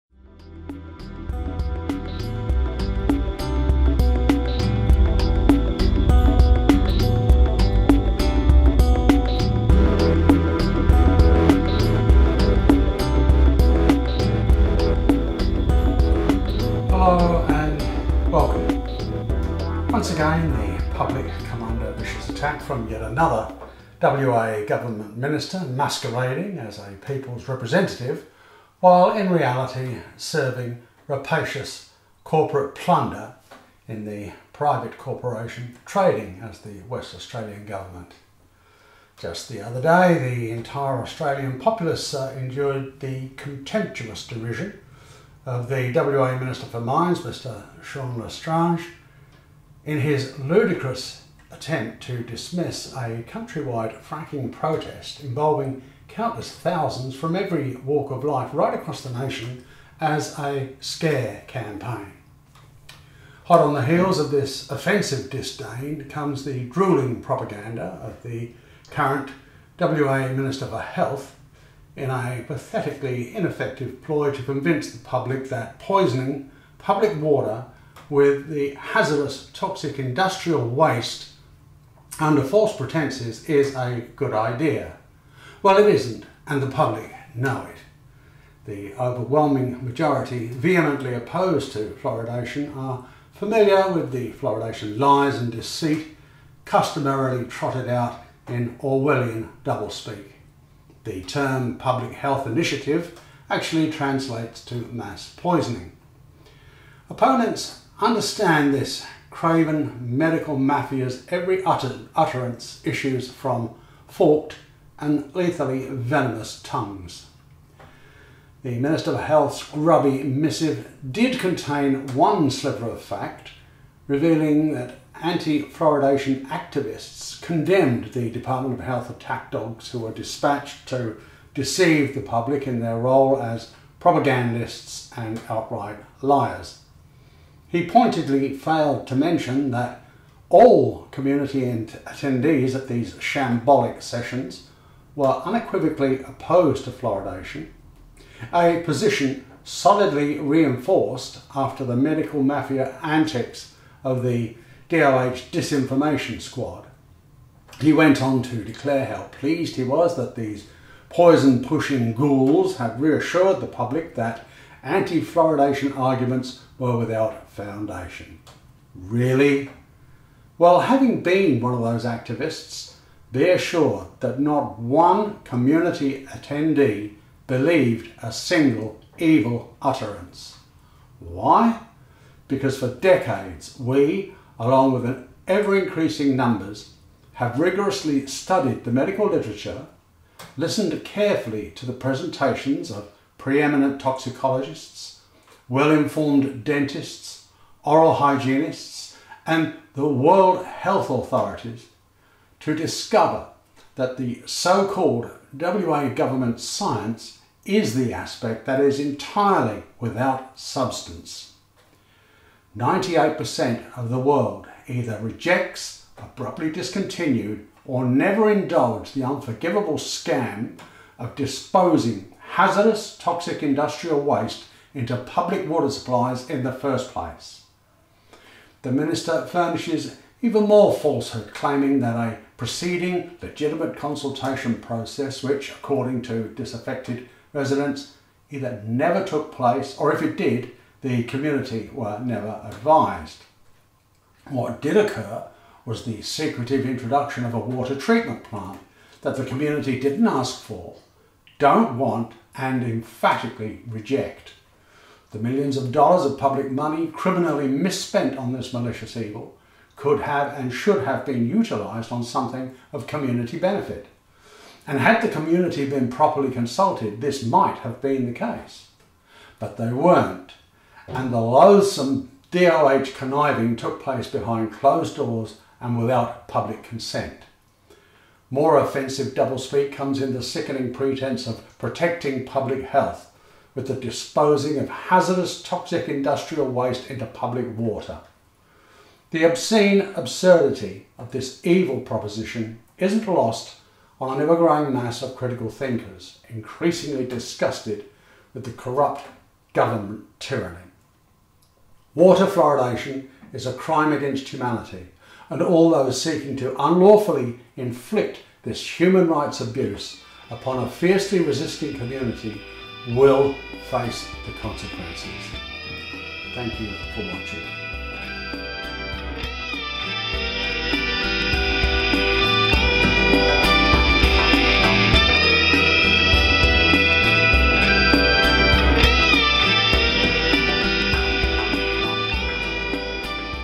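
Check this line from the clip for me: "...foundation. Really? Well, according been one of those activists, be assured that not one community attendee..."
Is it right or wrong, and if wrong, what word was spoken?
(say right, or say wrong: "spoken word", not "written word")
wrong: "having", not "according".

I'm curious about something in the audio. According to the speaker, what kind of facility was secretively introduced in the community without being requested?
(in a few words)
water treatment plant.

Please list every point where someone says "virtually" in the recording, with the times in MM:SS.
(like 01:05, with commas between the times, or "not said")
not said.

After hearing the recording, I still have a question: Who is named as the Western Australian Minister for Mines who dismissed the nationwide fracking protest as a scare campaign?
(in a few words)
Sean L'Estrange.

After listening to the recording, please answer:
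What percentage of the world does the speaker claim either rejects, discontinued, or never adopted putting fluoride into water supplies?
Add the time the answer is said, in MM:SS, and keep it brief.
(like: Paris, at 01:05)
98%, at 03:32.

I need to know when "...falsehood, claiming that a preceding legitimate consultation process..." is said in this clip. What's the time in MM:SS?
03:50.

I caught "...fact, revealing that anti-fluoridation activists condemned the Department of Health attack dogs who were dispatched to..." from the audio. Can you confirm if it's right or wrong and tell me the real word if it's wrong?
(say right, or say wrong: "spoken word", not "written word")
right.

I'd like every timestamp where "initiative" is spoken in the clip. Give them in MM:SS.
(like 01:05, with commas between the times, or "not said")
01:42.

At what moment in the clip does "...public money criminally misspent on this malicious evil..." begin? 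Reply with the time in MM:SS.
04:16.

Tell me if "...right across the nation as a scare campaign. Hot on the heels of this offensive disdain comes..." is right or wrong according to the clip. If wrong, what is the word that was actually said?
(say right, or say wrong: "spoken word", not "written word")
right.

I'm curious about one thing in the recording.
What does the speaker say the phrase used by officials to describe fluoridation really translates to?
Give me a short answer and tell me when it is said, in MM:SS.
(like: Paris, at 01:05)
mass poisoning, at 01:44.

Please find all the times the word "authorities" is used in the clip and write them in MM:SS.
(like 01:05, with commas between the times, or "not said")
03:21.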